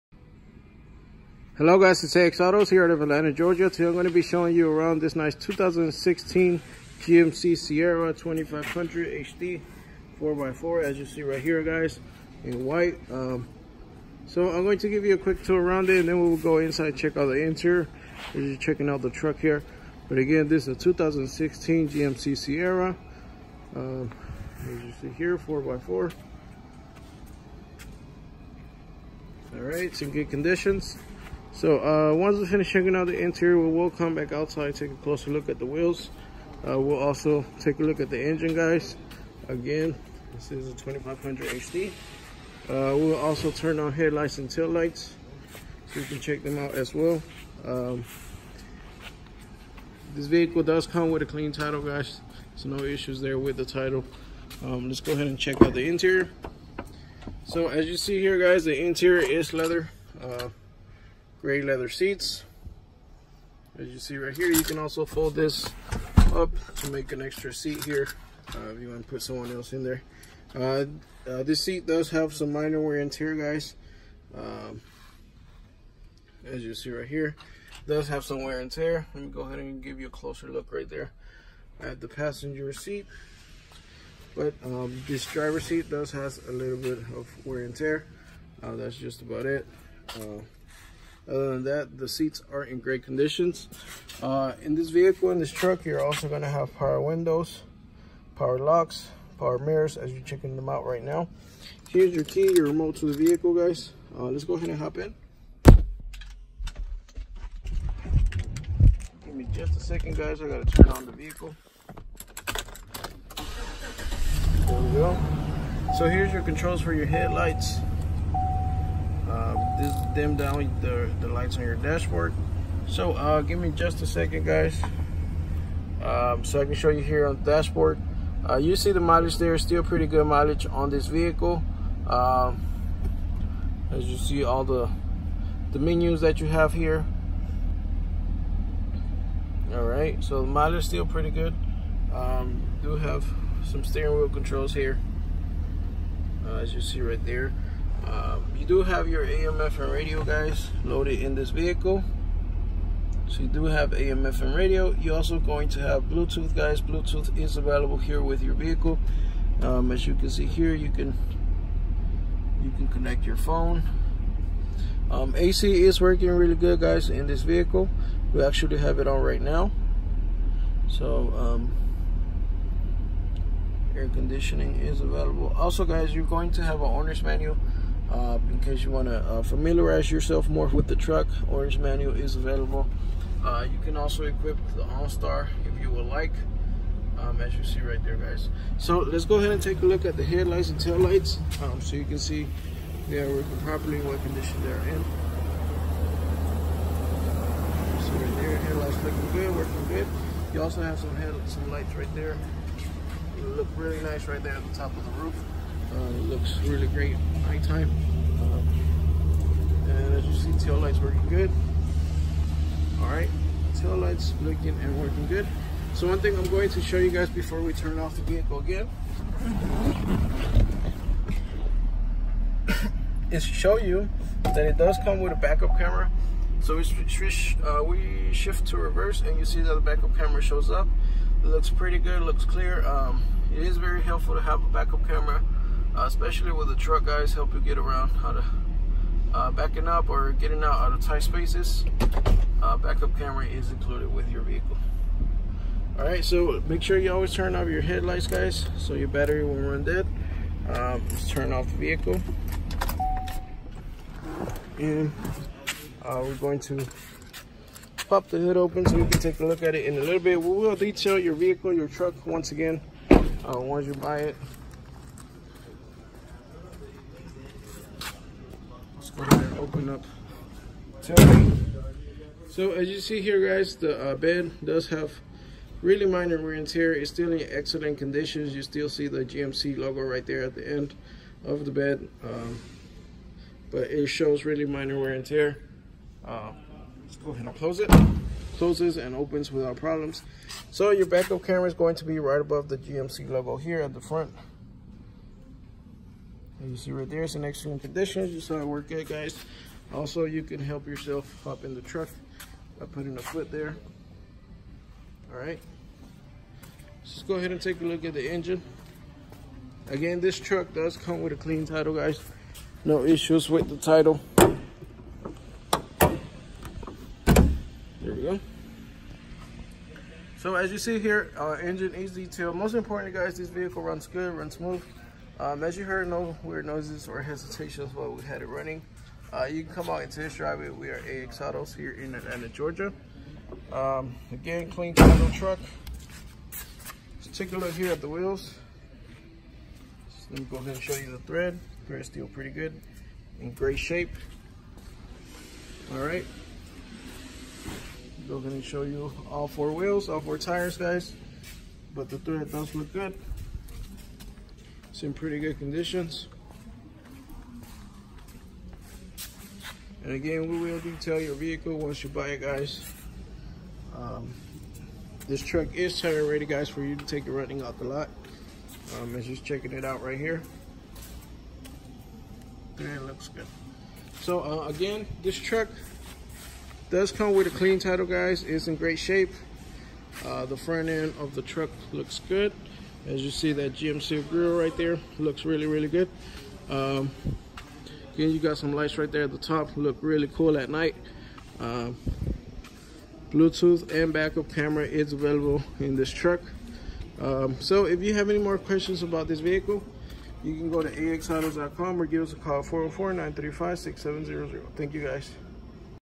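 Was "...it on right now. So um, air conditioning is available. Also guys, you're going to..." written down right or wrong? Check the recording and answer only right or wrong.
right.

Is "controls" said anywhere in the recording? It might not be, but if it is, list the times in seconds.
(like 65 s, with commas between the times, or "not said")
116 s, 144 s.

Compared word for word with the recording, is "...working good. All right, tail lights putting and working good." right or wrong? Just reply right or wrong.
wrong.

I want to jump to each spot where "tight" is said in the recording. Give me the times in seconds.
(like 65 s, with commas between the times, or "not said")
241 s.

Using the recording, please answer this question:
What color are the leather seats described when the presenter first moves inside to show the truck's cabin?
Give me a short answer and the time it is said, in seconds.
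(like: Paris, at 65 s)
Gray, at 61 s.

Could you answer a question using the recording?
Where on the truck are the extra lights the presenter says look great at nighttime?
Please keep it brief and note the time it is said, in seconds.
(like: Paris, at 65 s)
Top of the roof, at 204 s.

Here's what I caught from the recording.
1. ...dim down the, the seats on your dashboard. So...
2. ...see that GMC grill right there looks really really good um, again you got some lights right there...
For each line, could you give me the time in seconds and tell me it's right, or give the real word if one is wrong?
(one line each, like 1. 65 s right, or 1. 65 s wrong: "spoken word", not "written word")
1. 120 s wrong: "lights", not "seats"
2. 383 s right.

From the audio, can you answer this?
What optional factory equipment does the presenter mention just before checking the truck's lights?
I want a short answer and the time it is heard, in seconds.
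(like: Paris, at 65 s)
OnStar, at 184 s.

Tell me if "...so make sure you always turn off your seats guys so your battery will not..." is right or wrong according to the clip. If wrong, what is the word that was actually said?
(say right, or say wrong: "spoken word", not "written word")
wrong: "headlights", not "seats".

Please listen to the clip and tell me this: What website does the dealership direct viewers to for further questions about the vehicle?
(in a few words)
axautos.com.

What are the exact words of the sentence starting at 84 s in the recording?
But um, this driver seat does has a little bit of wear and tear.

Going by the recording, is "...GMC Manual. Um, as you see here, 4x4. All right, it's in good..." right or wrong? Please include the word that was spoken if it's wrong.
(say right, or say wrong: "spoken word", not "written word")
wrong: "Sierra", not "Manual".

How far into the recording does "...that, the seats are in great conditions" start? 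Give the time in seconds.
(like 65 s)
91 s.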